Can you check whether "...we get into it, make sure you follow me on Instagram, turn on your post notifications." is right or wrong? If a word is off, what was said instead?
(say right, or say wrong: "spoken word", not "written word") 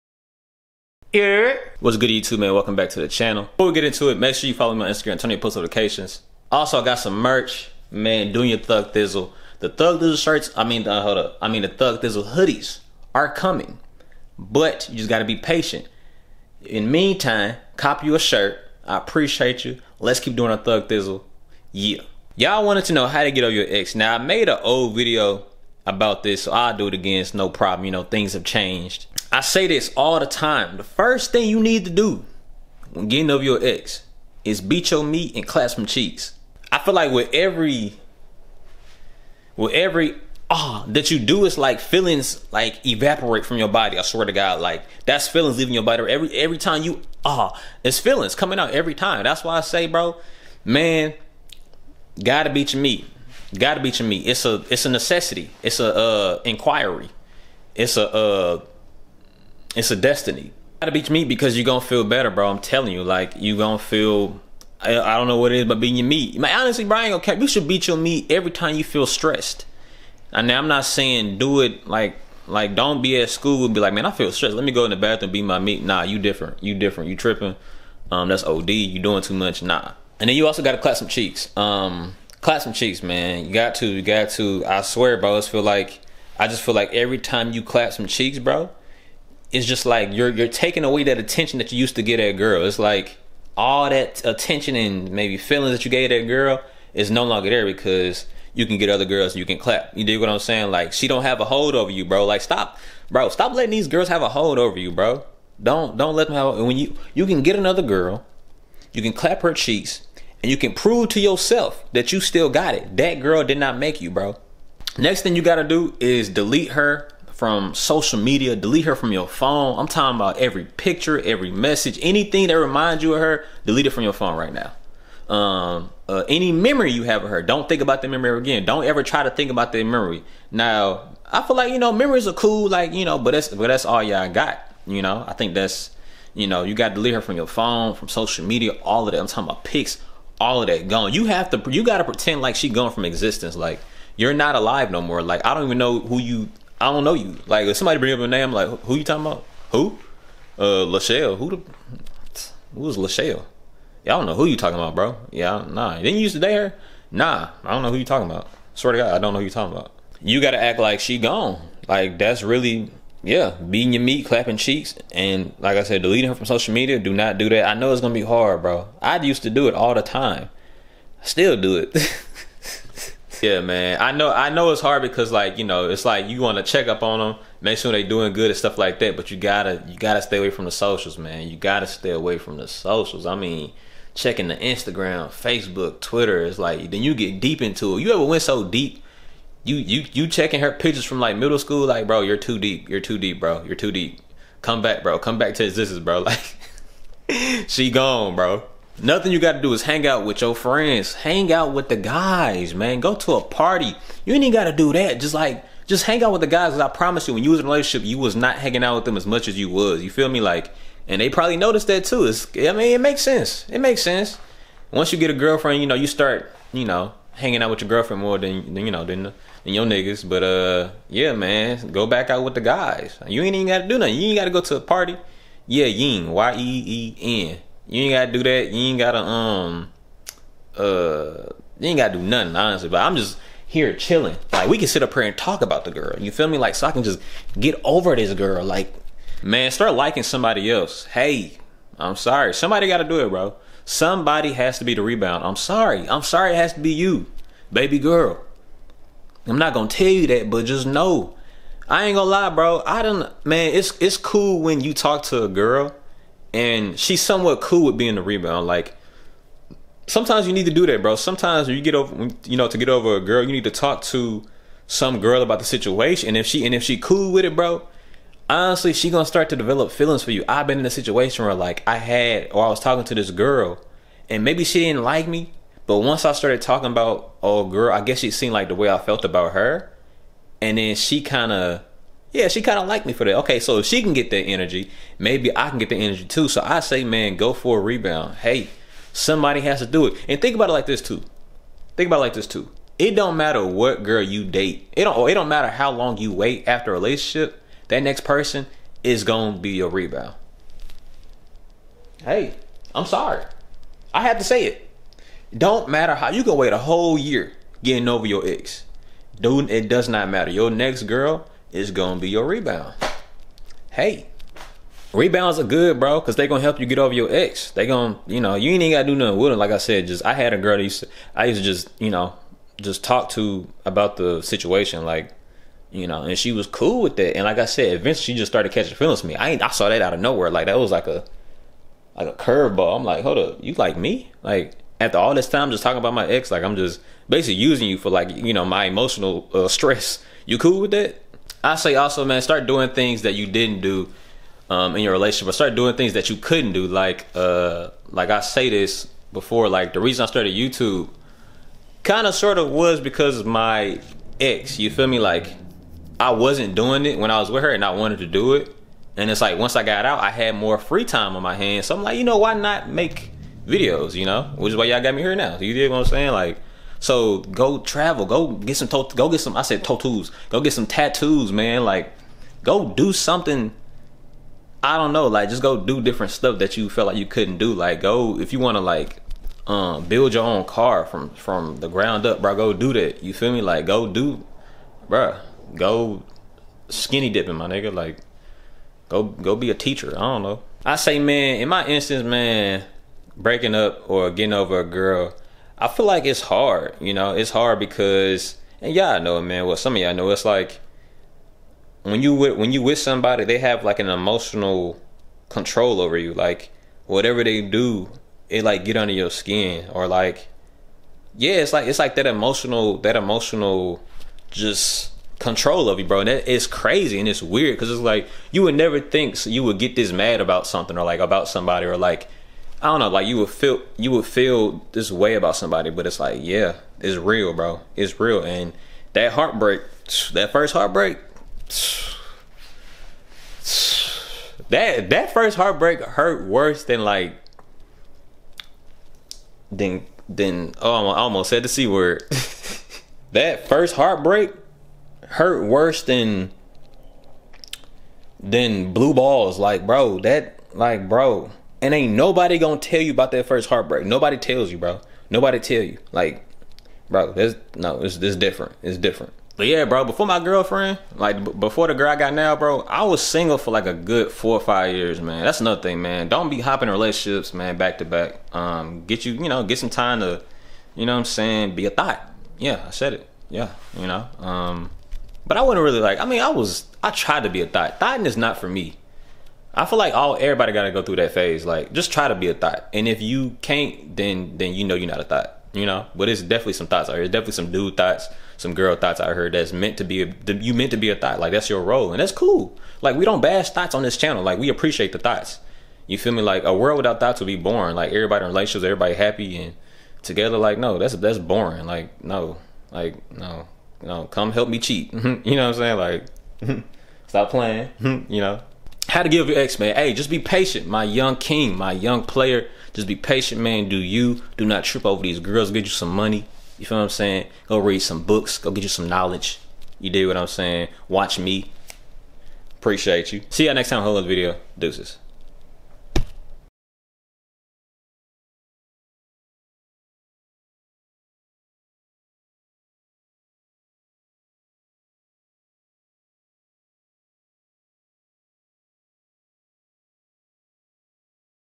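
right.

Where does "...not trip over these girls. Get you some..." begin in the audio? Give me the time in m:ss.
8:34.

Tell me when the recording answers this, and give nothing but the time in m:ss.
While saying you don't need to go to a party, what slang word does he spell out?
3:46.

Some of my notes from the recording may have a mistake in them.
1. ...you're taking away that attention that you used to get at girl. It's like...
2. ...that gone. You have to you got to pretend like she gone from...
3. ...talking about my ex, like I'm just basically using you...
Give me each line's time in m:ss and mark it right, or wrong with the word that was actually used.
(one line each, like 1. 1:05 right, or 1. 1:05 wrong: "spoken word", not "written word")
1. 1:30 right
2. 2:20 right
3. 5:35 right.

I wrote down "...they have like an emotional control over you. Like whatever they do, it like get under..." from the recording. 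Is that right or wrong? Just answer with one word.
right.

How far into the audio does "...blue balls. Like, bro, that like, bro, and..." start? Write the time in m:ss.
7:28.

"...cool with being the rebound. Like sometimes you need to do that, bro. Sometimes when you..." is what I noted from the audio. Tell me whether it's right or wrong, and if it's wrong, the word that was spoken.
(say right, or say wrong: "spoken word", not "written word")
right.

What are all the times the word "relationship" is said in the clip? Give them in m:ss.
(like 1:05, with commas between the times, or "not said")
3:27, 4:56, 5:45, 7:46, 8:18.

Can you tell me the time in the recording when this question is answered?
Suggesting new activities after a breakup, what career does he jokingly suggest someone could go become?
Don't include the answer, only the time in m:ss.
6:29.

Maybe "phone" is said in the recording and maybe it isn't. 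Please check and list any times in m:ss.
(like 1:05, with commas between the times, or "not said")
1:59, 2:04, 2:17.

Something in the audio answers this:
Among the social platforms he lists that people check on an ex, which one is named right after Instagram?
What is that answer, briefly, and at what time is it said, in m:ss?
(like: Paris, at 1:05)
Facebook, at 3:05.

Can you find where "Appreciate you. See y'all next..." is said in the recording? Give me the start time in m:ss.
8:42.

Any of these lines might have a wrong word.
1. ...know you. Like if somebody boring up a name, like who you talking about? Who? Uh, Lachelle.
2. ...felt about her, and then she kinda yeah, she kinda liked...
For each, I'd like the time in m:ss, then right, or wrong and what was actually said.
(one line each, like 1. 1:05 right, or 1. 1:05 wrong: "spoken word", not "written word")
1. 2:27 wrong: "bring", not "boring"
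2. 4:38 right.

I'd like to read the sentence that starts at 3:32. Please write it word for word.
It's, I mean, it makes sense.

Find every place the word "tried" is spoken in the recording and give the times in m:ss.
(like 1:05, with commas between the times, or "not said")
7:57.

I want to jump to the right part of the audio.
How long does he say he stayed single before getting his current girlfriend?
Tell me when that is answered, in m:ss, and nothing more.
7:44.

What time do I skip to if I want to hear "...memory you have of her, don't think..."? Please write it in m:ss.
2:06.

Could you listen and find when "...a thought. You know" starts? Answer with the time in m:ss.
8:05.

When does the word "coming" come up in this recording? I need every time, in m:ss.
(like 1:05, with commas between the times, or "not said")
0:13, 0:48.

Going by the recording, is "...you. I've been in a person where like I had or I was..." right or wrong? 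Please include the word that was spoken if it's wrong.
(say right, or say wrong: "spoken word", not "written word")
wrong: "situation", not "person".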